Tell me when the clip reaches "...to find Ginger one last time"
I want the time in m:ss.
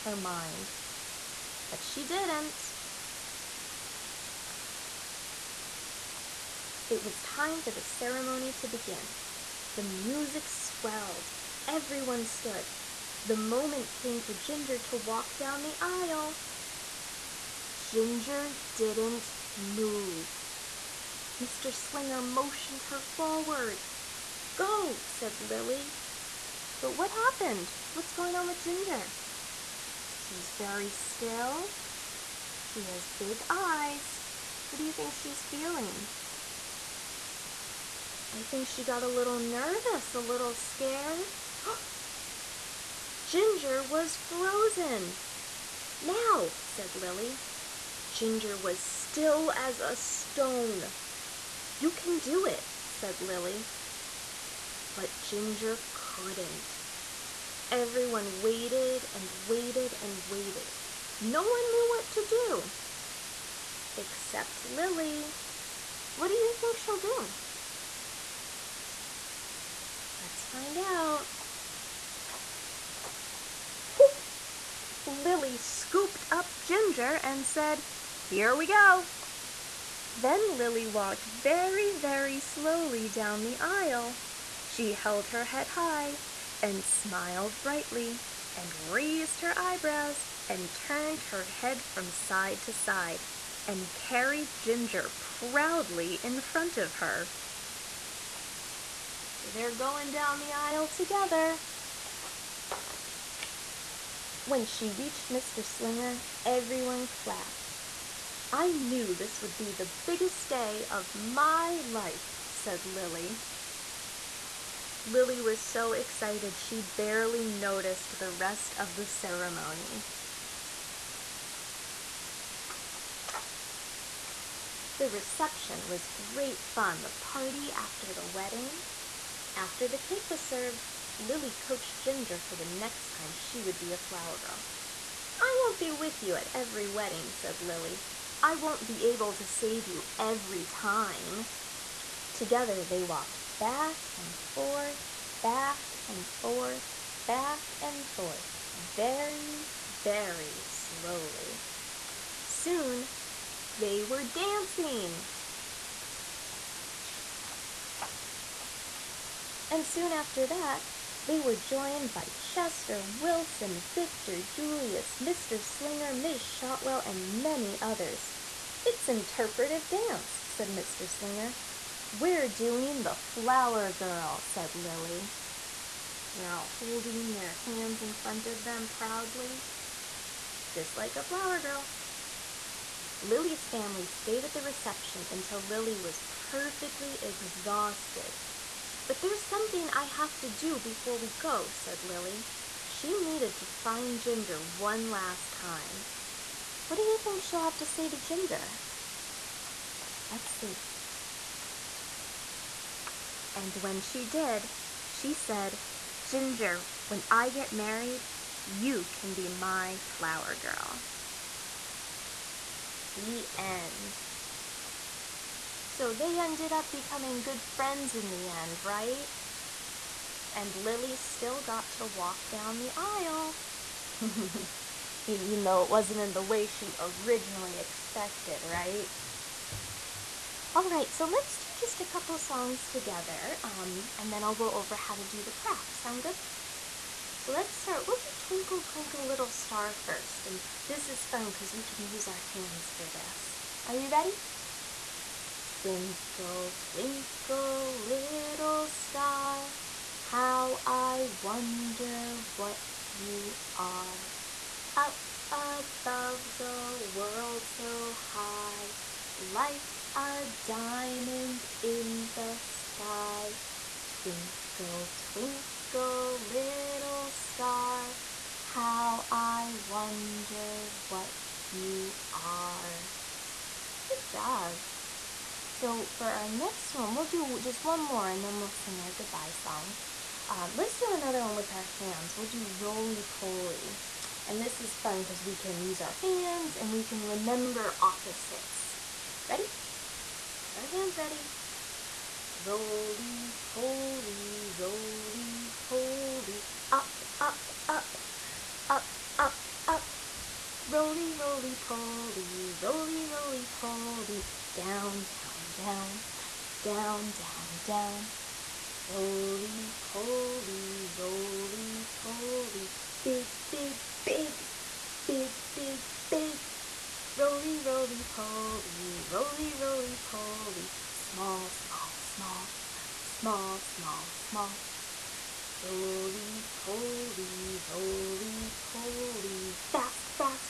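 3:13.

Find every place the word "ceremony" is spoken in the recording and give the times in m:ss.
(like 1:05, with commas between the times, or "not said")
0:07, 1:59.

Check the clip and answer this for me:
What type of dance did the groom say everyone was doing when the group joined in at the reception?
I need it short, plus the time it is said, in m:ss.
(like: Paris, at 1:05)
Interpretive dance, at 2:49.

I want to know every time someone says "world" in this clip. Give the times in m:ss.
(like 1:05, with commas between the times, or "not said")
4:17.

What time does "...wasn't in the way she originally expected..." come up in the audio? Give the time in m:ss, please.
3:45.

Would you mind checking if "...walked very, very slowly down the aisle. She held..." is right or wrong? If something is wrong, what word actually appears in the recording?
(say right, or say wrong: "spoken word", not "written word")
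right.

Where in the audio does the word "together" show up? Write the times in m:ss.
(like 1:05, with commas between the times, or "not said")
1:40, 2:22, 3:52.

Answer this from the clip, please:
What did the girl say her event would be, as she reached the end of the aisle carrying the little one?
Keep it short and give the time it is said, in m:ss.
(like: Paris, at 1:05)
The biggest day of my life, at 1:49.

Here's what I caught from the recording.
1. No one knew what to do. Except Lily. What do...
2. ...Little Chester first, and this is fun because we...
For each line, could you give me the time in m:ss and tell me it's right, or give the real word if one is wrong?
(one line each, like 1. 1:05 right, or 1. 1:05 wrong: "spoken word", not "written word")
1. 1:01 right
2. 3:59 wrong: "Star", not "Chester".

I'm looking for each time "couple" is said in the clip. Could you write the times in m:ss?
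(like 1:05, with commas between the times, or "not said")
3:52.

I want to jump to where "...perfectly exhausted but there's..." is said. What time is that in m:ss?
3:06.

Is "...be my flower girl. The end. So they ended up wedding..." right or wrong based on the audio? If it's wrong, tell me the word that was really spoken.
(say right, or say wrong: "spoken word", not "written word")
wrong: "becoming", not "wedding".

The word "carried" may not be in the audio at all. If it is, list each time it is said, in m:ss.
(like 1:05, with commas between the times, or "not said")
1:33.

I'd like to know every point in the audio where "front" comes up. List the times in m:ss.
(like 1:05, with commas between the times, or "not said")
1:36, 2:58.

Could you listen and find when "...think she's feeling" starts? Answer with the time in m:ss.
0:34.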